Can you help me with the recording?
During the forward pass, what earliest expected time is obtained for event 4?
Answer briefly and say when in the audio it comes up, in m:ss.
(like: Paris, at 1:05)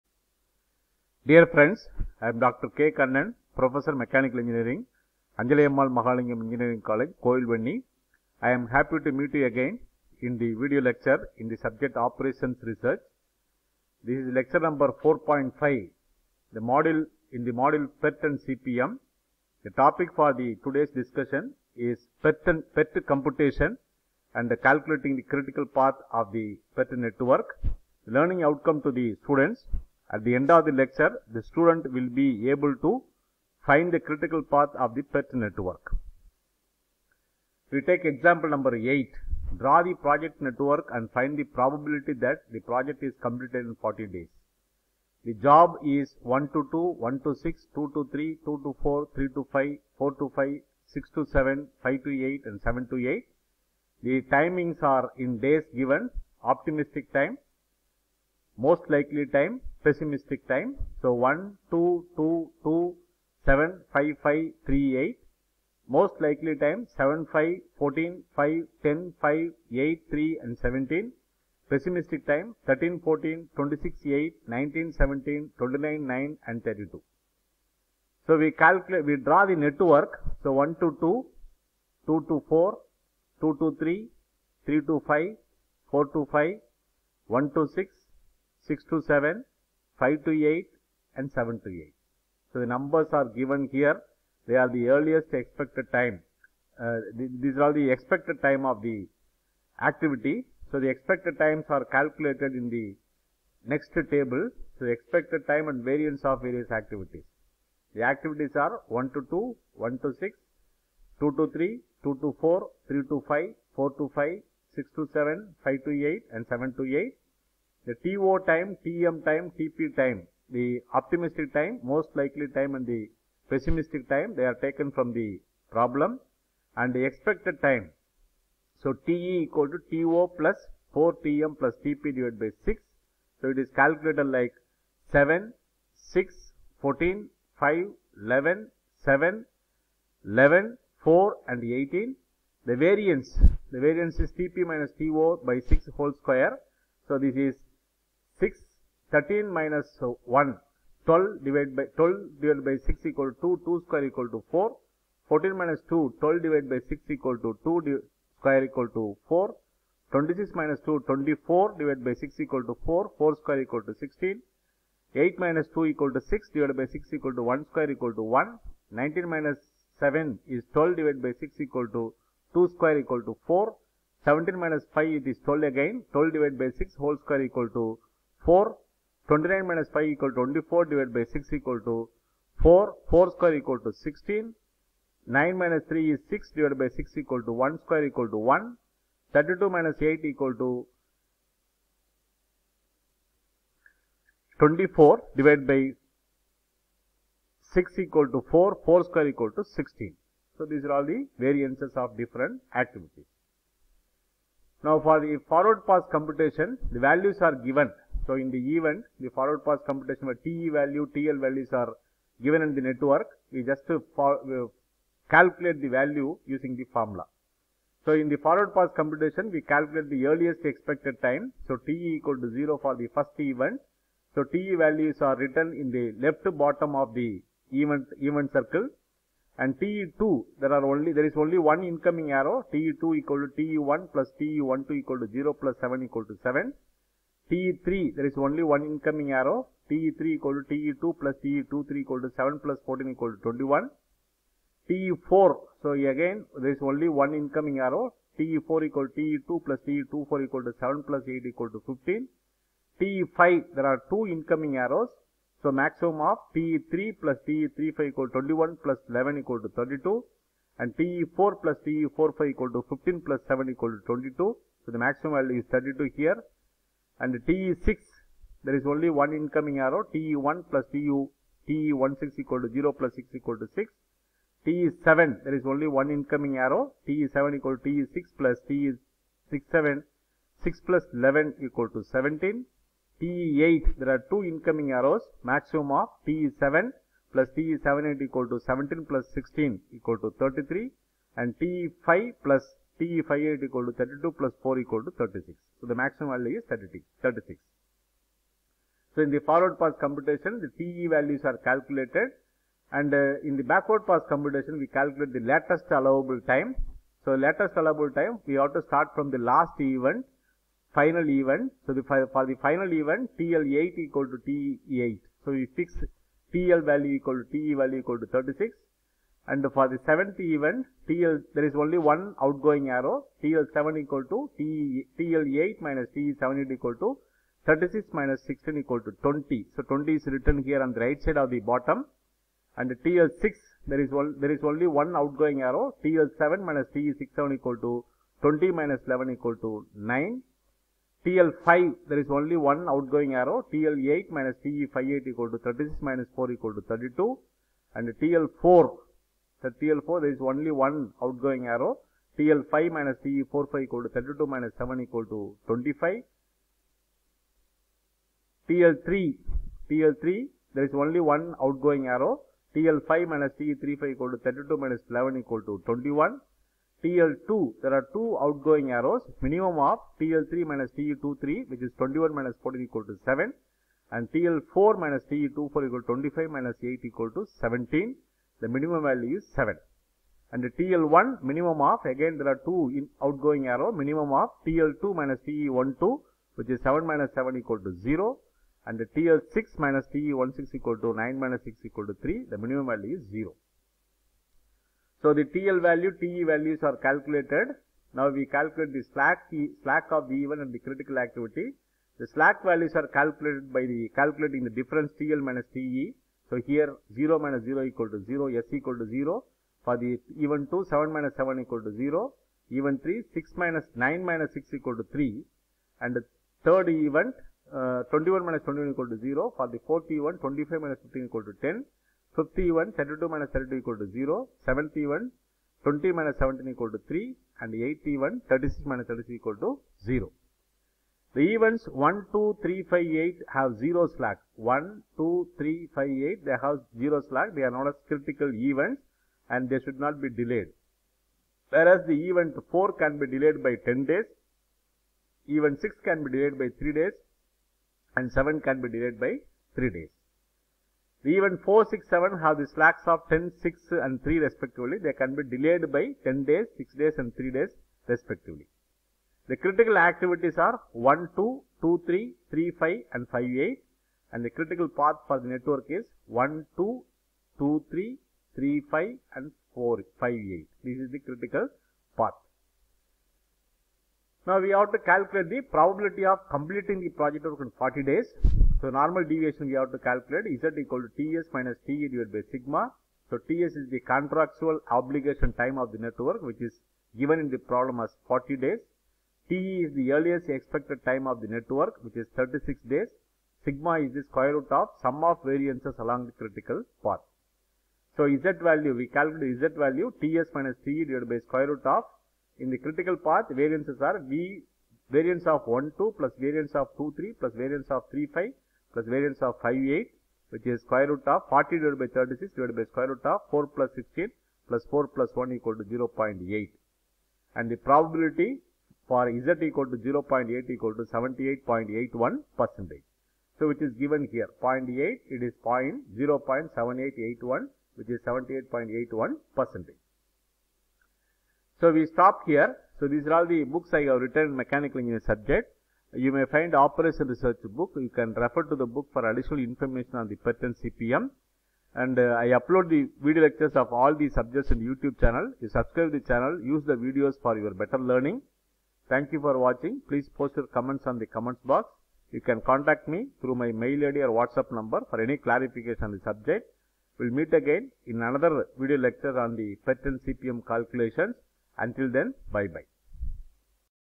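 15, at 4:10.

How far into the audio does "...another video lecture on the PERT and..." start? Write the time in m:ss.
9:18.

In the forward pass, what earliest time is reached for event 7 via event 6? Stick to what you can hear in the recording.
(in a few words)
17.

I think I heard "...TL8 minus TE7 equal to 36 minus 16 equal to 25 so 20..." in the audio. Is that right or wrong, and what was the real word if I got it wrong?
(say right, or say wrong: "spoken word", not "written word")
wrong: "20", not "25".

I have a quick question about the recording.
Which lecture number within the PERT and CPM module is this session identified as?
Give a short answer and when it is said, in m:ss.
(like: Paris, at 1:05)
4.5, at 0:15.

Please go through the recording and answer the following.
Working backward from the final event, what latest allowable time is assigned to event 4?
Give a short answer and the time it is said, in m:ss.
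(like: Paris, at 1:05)
25, at 5:54.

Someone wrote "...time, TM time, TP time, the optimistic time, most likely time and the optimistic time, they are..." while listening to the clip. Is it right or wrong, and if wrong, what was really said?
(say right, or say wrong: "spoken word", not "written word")
wrong: "pessimistic", not "optimistic".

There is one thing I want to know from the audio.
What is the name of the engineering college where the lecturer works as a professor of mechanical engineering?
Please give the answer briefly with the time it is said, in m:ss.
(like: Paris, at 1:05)
Anjalayammal Mahalingam Engineering College, at 0:05.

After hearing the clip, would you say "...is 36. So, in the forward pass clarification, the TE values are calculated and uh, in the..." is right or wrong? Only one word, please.
wrong.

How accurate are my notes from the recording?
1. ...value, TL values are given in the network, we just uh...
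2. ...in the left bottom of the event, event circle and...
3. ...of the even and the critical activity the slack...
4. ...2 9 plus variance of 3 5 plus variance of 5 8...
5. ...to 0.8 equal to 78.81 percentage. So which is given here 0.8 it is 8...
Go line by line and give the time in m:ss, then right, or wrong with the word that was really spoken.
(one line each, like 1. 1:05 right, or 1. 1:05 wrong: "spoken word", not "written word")
1. 3:30 right
2. 3:45 right
3. 6:40 right
4. 8:26 wrong: "3", not "9"
5. 8:39 wrong: "0", not "8".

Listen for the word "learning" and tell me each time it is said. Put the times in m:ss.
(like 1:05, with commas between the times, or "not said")
0:28, 9:08.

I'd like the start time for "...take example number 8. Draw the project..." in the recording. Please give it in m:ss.
0:37.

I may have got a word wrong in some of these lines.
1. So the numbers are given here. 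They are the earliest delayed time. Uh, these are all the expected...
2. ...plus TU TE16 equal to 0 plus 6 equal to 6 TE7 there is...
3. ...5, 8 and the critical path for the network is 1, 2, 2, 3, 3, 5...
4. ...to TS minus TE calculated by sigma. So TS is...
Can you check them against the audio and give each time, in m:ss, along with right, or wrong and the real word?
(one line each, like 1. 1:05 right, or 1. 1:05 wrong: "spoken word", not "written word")
1. 1:32 wrong: "expected", not "delayed"
2. 4:30 right
3. 7:43 right
4. 8:01 wrong: "divided", not "calculated".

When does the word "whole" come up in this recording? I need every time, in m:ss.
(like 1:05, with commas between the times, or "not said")
2:25, 2:56.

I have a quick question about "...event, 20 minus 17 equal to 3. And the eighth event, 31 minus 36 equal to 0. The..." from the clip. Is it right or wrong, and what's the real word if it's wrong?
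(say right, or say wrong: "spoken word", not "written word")
wrong: "36", not "31".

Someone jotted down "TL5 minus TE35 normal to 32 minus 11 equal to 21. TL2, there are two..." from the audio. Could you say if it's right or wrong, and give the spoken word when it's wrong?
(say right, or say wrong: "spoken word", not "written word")
wrong: "equal", not "normal".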